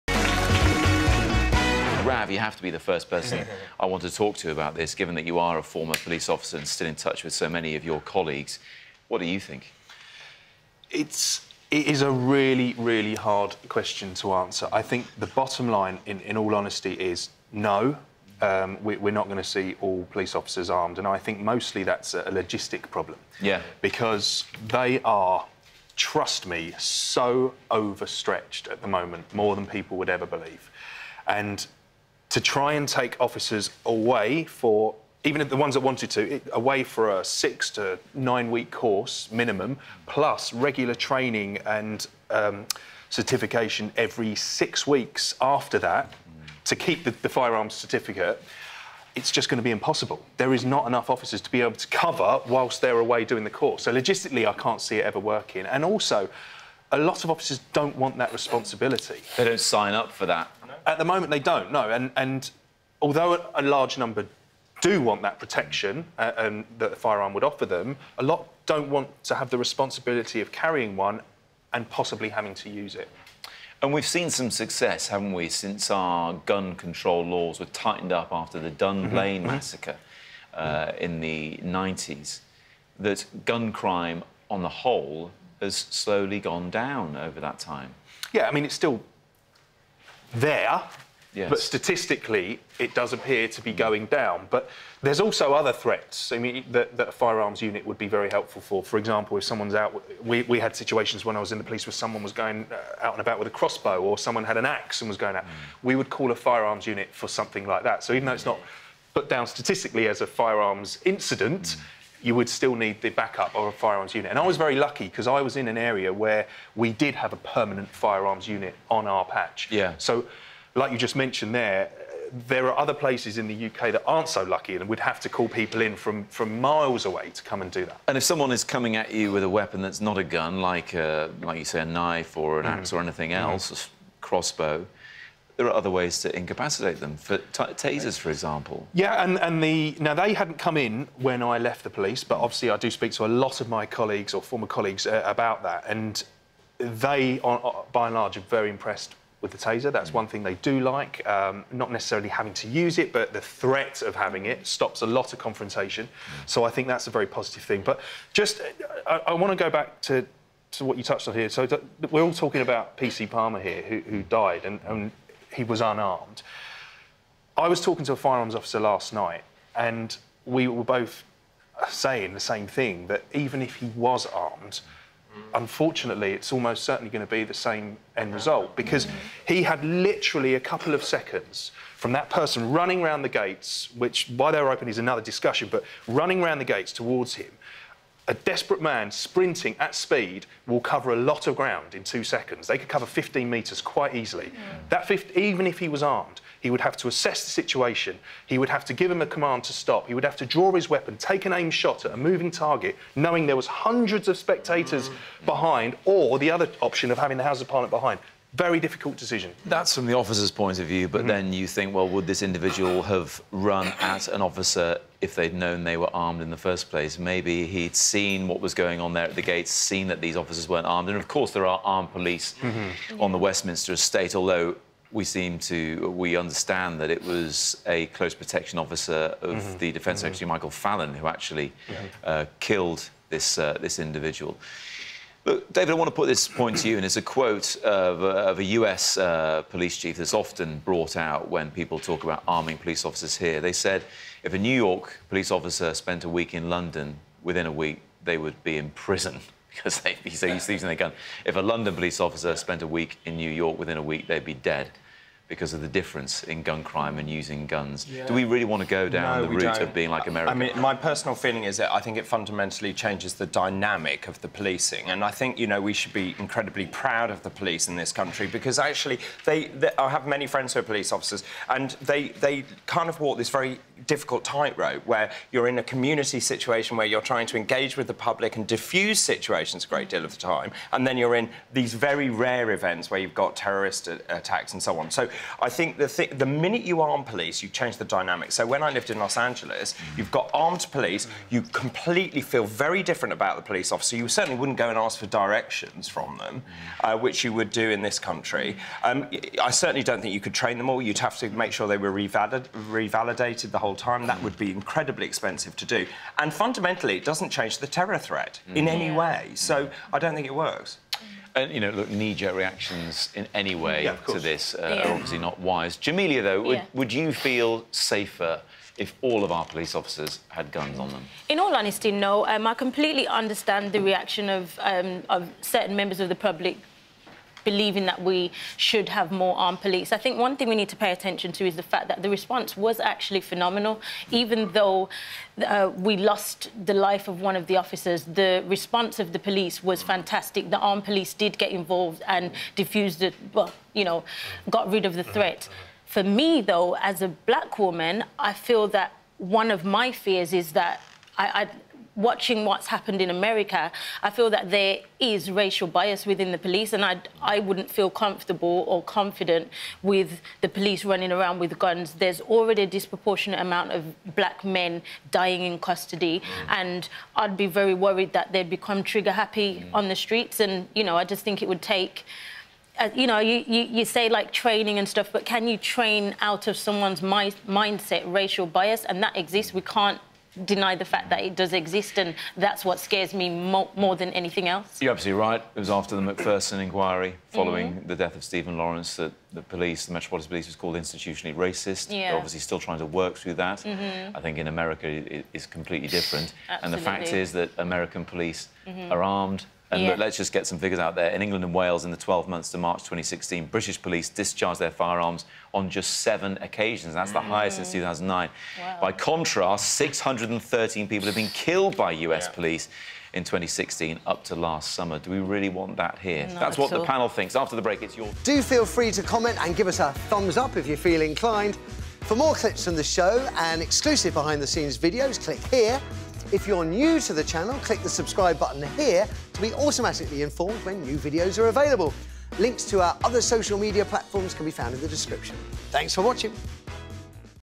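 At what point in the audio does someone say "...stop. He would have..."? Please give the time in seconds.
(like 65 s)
199 s.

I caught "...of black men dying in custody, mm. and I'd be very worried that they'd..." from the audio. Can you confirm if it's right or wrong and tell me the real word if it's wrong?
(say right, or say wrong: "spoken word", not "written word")
right.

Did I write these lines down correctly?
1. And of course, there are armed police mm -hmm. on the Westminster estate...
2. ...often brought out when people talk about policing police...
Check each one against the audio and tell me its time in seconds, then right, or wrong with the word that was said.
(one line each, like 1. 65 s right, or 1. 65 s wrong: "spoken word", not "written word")
1. 221 s right
2. 240 s wrong: "arming", not "policing".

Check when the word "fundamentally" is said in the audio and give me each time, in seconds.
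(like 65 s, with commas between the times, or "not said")
262 s, 306 s.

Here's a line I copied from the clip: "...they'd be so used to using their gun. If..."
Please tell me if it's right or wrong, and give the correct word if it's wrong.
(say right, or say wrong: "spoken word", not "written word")
right.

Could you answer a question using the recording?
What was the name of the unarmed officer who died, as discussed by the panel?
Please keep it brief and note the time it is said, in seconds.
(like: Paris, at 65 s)
PC Palmer, at 162 s.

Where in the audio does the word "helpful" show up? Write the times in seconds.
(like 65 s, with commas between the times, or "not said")
98 s.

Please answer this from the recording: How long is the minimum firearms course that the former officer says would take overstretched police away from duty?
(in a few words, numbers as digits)
6 to 9 weeks.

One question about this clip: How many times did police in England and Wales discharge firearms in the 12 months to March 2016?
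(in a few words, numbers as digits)
7.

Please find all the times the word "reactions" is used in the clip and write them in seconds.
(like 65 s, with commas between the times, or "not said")
312 s, 323 s.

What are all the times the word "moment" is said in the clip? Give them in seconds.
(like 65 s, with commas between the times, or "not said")
28 s, 61 s.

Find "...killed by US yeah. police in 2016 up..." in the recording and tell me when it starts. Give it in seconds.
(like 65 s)
411 s.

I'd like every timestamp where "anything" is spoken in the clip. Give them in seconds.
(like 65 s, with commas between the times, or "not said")
133 s, 384 s.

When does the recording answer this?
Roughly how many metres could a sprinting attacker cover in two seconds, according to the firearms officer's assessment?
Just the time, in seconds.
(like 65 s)
193 s.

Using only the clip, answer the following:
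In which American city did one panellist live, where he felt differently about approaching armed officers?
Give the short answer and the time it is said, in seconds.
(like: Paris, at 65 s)
Los Angeles, at 289 s.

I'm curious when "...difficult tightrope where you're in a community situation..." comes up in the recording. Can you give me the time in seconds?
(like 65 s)
274 s.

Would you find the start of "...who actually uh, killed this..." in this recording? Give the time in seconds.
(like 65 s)
231 s.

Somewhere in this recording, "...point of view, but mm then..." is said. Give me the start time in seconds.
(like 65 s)
210 s.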